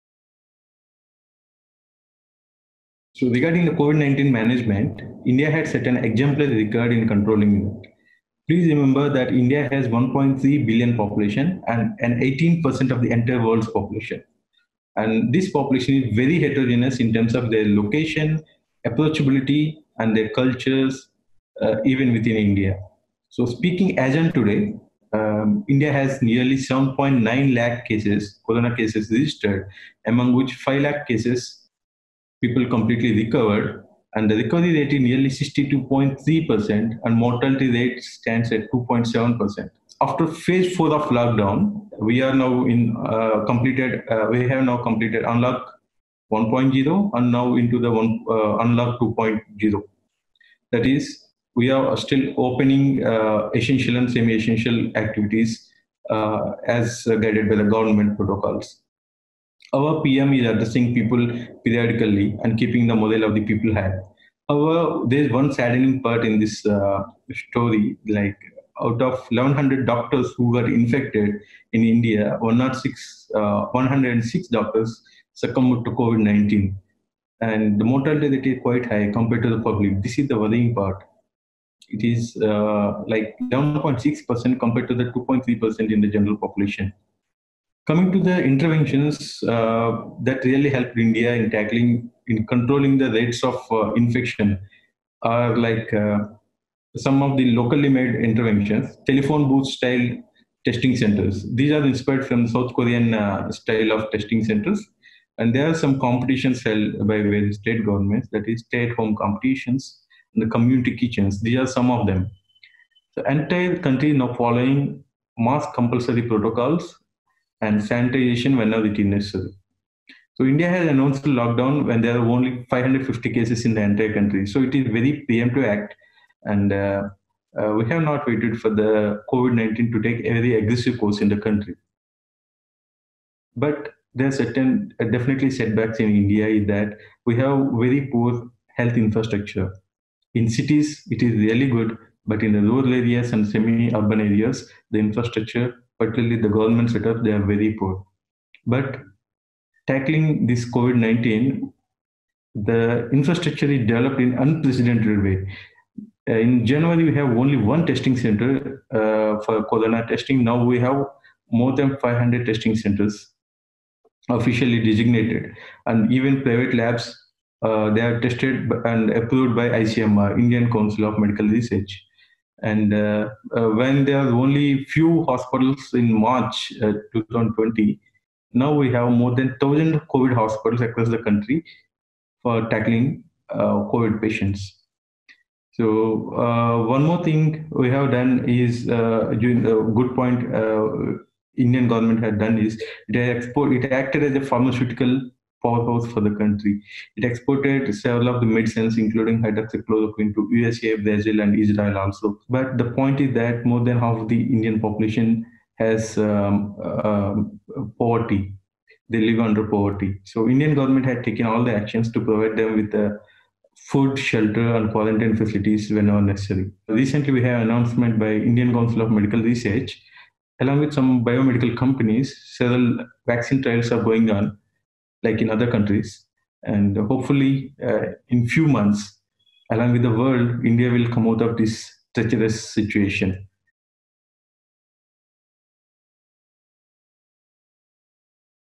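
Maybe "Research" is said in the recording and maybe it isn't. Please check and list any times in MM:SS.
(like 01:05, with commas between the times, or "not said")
02:51, 03:39.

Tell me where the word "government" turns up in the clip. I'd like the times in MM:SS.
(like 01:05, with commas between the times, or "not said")
00:57, 01:47, 02:26, 03:11, 03:30.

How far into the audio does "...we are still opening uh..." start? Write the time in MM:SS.
00:51.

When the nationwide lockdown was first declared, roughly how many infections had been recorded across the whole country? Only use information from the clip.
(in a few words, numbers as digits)
550.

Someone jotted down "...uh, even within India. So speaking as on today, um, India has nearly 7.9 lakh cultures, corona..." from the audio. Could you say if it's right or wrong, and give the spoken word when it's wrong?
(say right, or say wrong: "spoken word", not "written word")
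wrong: "cases", not "cultures".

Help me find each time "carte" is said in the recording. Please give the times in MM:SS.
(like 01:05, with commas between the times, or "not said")
not said.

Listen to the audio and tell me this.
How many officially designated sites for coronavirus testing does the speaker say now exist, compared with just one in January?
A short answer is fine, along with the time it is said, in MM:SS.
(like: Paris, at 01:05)
More than 500, at 02:41.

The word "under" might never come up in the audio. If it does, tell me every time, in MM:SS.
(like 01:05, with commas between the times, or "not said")
03:29.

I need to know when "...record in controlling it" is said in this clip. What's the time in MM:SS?
00:06.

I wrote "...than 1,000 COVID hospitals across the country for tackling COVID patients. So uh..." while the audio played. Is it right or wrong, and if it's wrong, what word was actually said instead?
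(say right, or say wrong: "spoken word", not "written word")
right.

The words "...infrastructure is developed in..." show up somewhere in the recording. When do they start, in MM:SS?
02:33.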